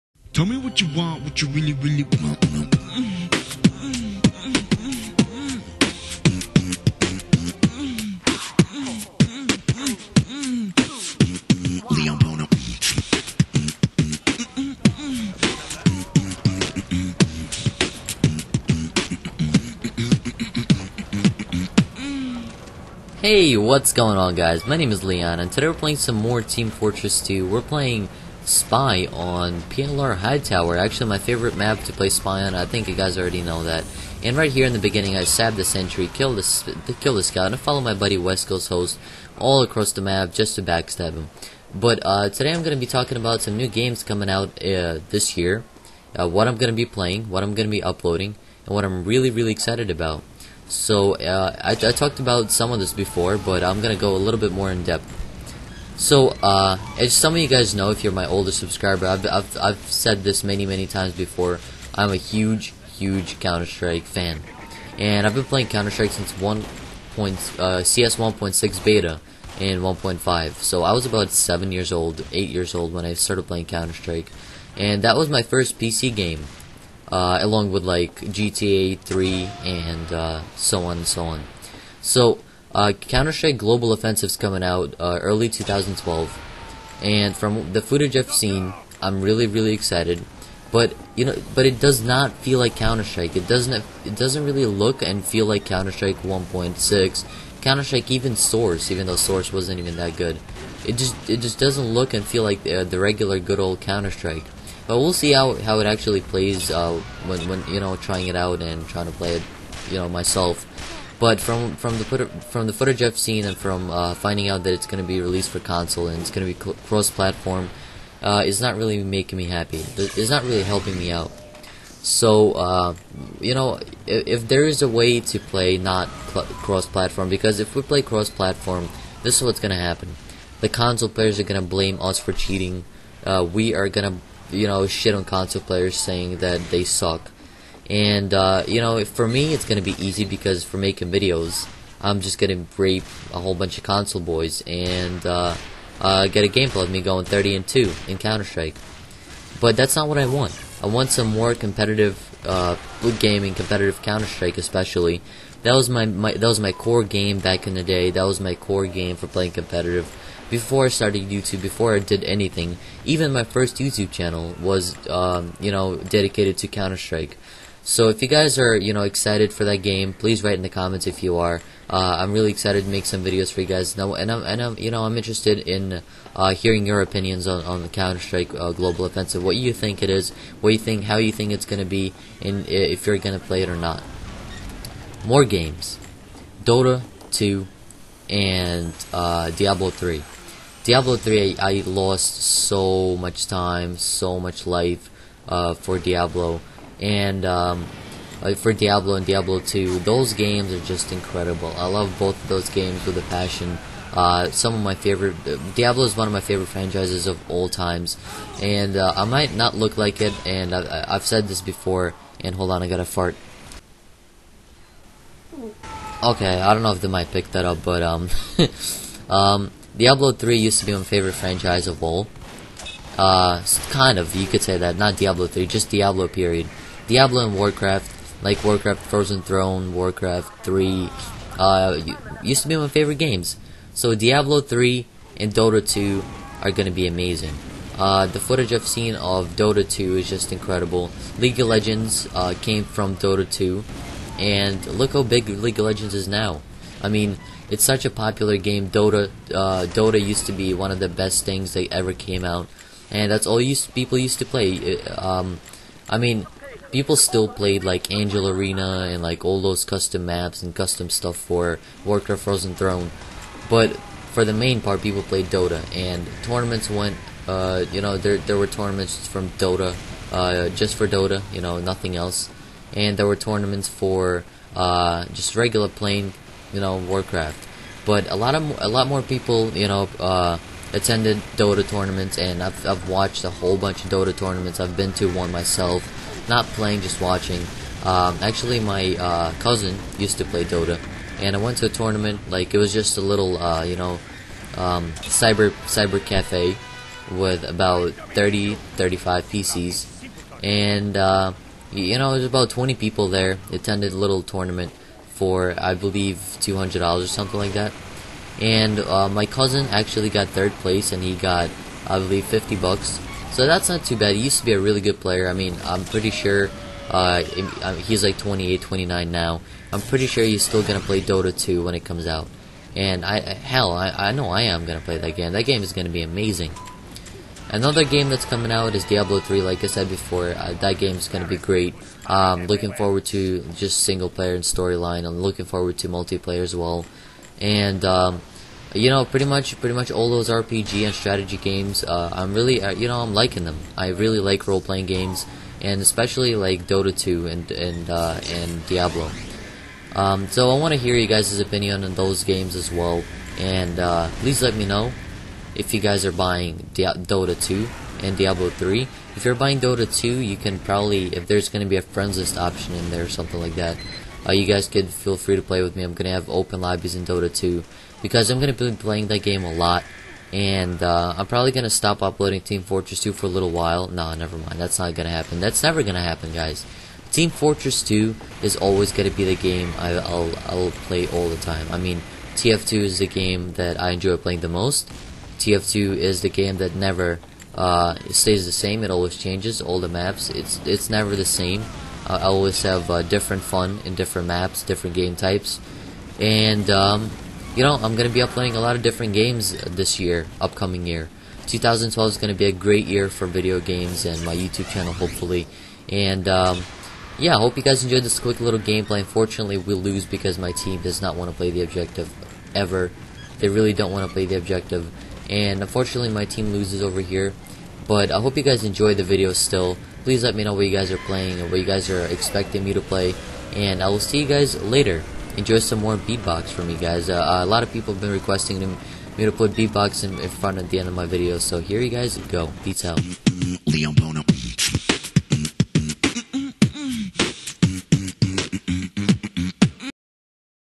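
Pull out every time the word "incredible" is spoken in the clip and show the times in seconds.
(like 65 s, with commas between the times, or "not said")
201 s, 240 s.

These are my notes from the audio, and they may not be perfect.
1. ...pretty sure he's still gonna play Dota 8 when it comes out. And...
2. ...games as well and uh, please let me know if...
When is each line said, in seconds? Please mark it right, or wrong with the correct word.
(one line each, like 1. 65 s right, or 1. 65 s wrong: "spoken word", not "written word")
1. 320 s wrong: "2", not "8"
2. 352 s right.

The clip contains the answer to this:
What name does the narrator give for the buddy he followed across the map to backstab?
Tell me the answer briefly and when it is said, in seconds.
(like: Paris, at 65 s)
West Coast Host, at 38 s.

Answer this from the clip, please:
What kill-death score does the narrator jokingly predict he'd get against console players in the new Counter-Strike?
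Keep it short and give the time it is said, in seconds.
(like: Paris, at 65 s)
30 and 2, at 147 s.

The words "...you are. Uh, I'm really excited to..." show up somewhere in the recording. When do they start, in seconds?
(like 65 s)
171 s.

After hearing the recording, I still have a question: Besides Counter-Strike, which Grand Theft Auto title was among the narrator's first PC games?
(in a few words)
GTA 3.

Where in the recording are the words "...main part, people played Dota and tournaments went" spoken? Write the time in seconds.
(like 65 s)
264 s.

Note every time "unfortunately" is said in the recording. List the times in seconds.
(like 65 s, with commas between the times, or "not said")
409 s, 415 s.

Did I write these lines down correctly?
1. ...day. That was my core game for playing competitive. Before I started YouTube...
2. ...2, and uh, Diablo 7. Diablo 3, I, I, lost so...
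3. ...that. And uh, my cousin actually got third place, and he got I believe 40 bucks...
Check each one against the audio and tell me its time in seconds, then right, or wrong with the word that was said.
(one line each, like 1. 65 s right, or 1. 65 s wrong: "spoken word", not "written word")
1. 157 s right
2. 187 s wrong: "3", not "7"
3. 307 s wrong: "50", not "40".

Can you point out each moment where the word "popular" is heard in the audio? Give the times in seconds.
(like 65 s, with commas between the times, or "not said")
248 s.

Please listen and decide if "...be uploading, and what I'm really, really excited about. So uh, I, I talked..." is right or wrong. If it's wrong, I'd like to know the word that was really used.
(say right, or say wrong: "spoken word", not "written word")
right.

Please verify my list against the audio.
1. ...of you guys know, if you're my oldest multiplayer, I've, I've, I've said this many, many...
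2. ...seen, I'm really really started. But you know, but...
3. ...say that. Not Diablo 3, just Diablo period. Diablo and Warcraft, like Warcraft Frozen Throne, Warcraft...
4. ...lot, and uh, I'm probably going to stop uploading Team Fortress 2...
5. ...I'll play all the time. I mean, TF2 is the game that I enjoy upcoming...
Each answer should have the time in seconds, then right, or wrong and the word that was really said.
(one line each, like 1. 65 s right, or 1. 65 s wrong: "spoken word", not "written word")
1. 57 s wrong: "subscriber", not "multiplayer"
2. 88 s wrong: "excited", not "started"
3. 224 s right
4. 369 s right
5. 380 s wrong: "playing", not "upcoming".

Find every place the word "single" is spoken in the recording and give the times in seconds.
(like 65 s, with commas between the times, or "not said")
334 s.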